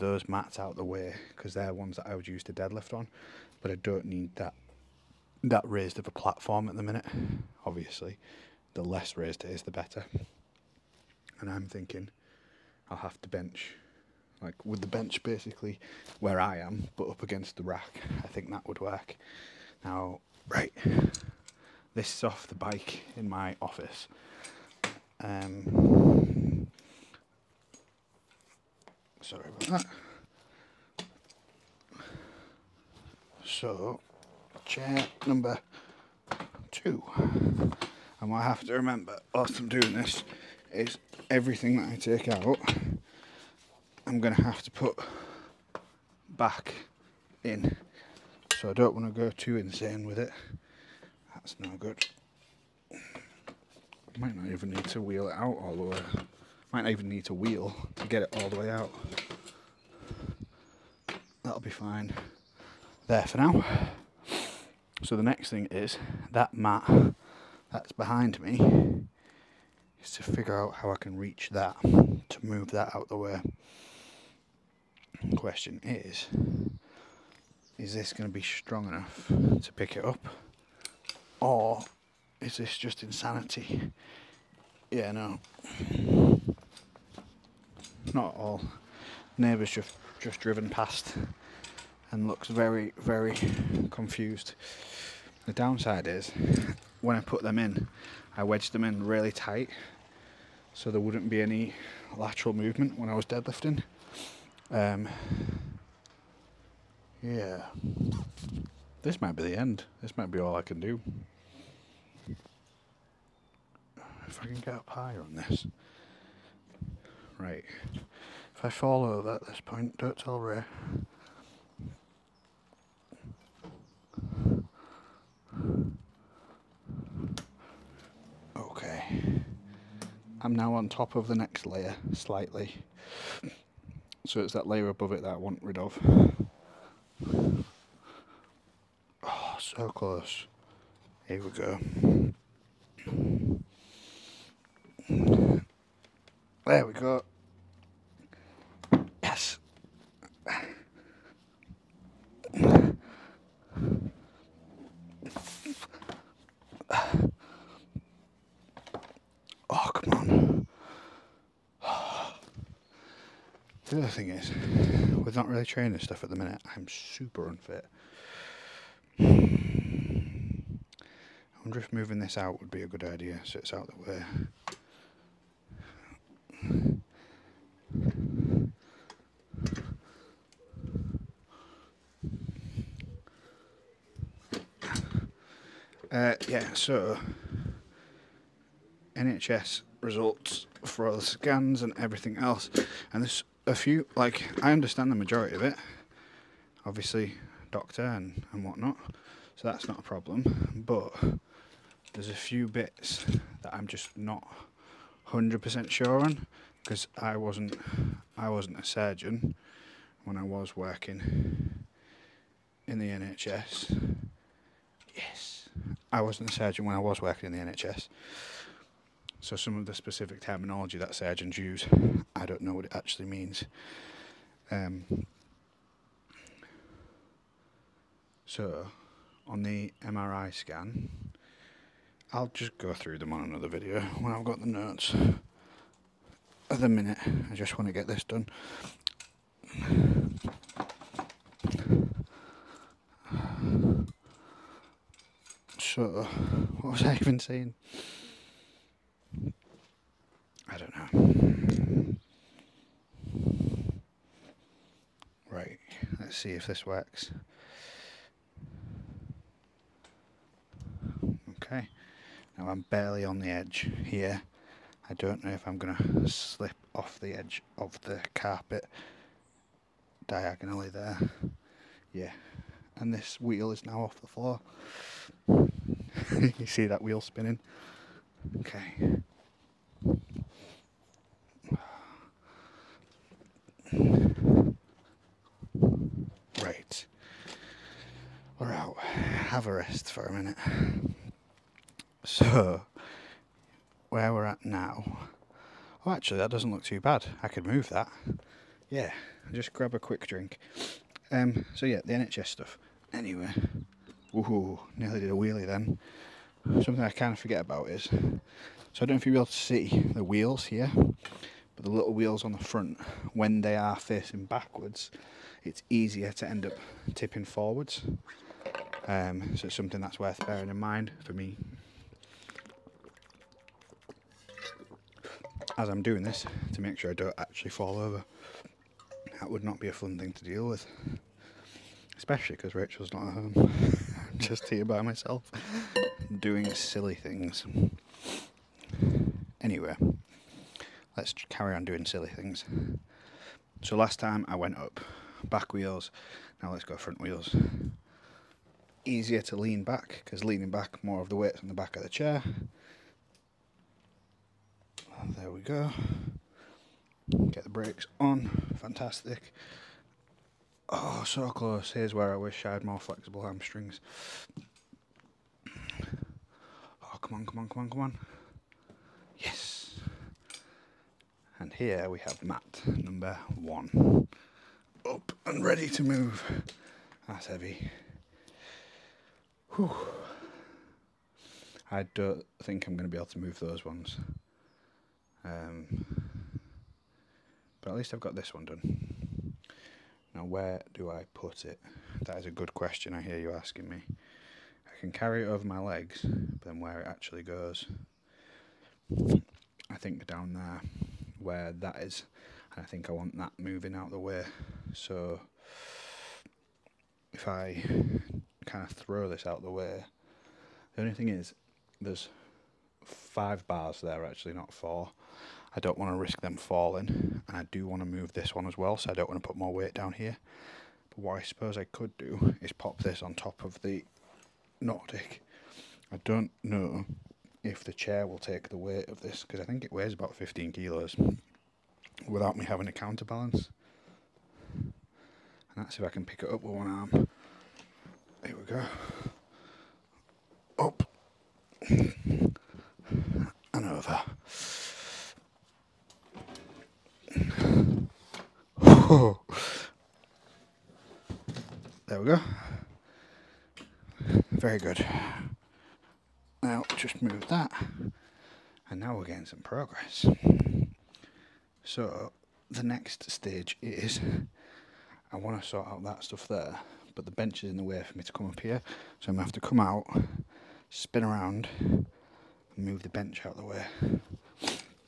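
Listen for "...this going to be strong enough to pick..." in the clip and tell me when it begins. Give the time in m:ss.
1:17.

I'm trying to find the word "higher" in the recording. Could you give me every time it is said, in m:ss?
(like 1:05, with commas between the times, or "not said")
1:54.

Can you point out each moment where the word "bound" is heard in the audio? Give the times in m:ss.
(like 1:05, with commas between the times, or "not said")
not said.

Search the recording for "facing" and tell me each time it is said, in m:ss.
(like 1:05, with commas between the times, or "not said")
5:13.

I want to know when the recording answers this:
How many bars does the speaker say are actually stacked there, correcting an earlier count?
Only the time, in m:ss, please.
6:53.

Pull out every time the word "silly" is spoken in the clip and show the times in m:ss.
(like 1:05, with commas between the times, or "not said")
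5:36, 5:42.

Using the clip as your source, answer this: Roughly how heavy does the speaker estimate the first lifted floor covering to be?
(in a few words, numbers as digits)
15 kilos.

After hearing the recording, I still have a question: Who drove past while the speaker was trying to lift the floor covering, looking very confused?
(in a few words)
Neighbors.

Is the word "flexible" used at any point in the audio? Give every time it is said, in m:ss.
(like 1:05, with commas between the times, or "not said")
6:02.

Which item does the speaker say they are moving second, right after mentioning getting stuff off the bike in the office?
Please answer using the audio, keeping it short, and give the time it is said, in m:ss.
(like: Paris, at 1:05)
Chair number two, at 0:34.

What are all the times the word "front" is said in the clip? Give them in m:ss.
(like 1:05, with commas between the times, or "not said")
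5:12, 5:46.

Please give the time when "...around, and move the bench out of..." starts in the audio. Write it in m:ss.
7:51.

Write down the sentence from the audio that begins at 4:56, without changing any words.
Oh, actually, that doesn't look too bad.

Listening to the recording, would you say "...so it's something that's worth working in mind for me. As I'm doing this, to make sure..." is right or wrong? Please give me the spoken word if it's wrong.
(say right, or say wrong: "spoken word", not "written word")
wrong: "bearing", not "working".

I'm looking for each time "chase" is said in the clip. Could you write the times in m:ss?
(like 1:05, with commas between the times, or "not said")
not said.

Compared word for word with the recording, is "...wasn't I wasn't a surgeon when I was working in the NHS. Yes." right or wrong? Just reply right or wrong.
right.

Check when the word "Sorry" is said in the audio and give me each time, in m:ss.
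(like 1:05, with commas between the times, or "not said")
0:29.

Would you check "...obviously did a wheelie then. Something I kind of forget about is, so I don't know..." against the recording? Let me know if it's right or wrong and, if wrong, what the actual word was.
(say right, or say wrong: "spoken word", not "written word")
wrong: "nearly", not "obviously".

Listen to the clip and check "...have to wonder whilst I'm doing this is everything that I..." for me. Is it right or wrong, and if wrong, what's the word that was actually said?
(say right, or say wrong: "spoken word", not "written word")
wrong: "remember", not "wonder".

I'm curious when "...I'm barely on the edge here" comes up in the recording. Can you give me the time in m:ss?
4:22.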